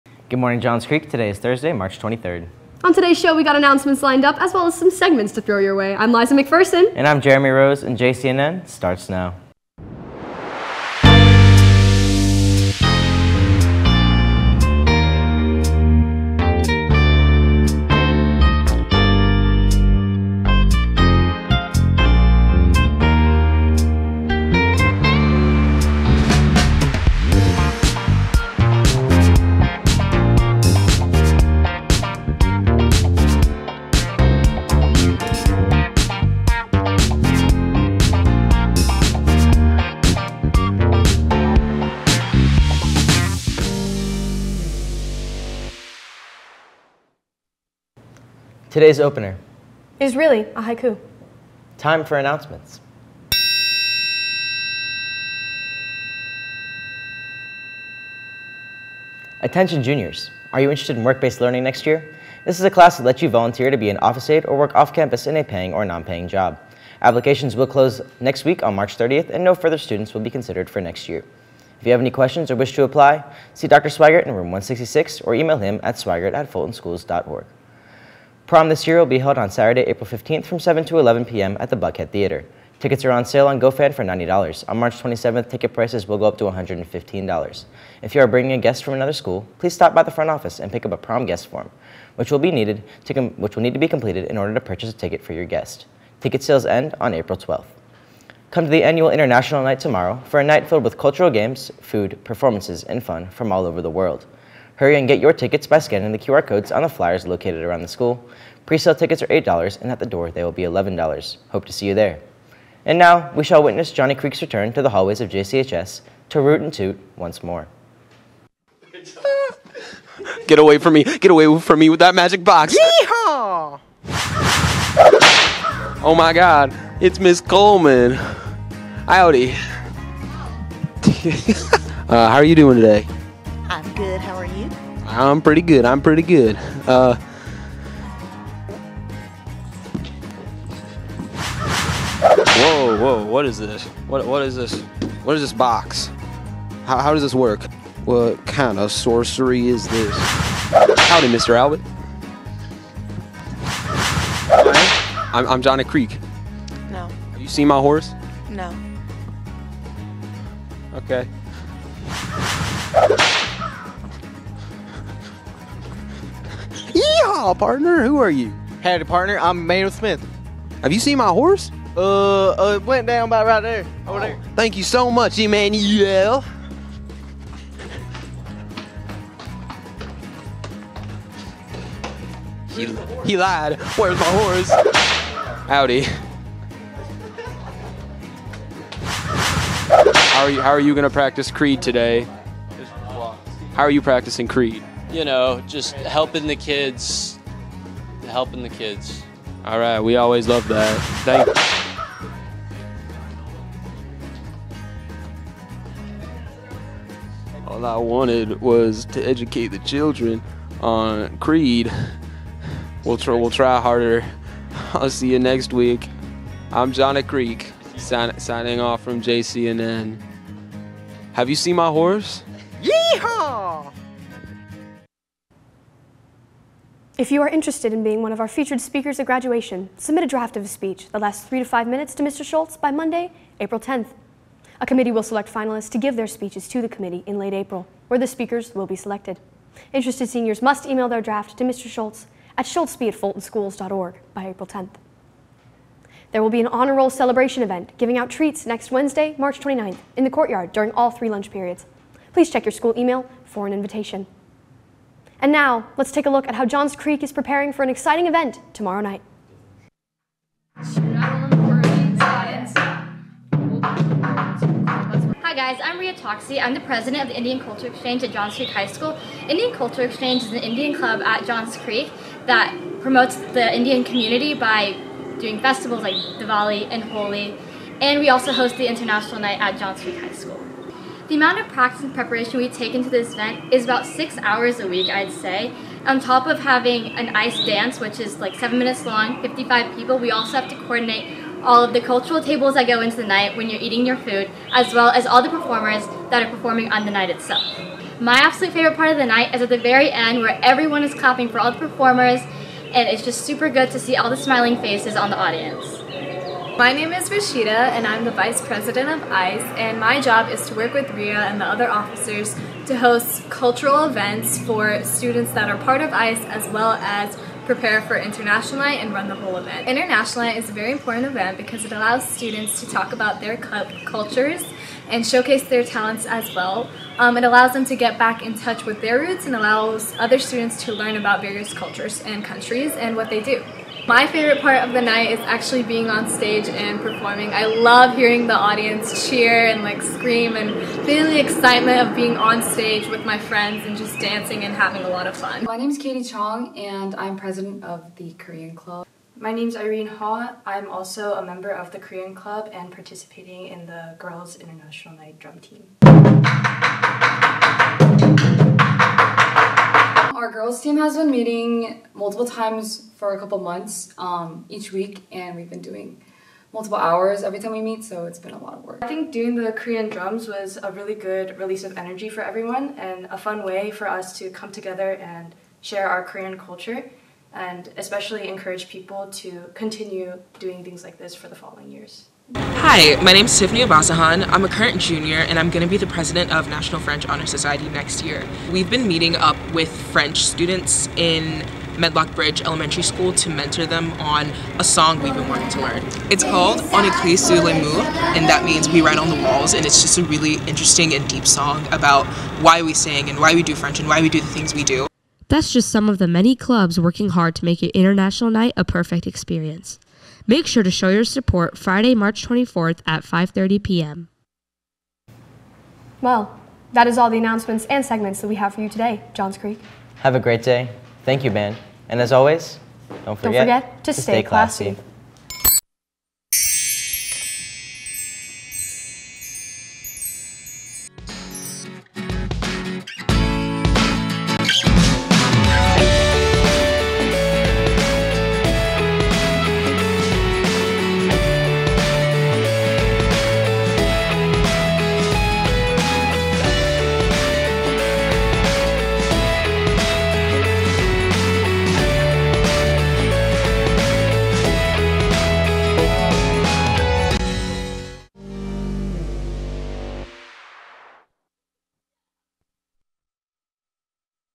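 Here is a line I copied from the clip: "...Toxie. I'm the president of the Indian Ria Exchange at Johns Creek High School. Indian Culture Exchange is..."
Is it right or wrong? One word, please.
wrong.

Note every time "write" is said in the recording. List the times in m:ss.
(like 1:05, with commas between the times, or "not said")
6:39.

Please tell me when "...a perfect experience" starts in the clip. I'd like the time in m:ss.
6:48.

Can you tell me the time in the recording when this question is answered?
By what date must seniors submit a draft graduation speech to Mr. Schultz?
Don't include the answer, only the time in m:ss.
3:52.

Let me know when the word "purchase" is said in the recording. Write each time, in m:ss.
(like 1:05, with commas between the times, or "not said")
1:34.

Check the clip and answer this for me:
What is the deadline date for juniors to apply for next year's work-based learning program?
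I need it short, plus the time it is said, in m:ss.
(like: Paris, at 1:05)
March 30th, at 1:08.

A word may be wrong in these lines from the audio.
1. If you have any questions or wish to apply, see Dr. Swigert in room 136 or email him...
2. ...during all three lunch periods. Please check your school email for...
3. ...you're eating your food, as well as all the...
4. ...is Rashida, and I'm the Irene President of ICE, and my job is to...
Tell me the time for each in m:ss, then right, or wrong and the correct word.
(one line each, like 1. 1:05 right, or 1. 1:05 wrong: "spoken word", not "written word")
1. 1:11 wrong: "166", not "136"
2. 4:10 right
3. 4:53 right
4. 5:07 wrong: "Vice", not "Irene".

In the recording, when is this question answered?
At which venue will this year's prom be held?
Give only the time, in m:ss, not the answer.
1:21.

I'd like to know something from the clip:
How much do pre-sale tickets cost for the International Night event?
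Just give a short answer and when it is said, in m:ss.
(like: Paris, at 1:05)
$8, at 1:49.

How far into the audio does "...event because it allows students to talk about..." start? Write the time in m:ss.
5:21.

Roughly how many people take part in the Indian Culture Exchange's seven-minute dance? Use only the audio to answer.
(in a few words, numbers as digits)
55.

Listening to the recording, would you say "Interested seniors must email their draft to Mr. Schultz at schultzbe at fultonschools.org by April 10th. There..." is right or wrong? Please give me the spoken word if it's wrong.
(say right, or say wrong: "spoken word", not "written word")
right.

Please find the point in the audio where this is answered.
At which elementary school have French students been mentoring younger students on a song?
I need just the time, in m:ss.
6:31.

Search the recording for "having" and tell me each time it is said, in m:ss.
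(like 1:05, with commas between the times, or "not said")
4:46, 5:44.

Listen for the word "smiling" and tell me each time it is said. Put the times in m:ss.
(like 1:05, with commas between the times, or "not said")
5:04.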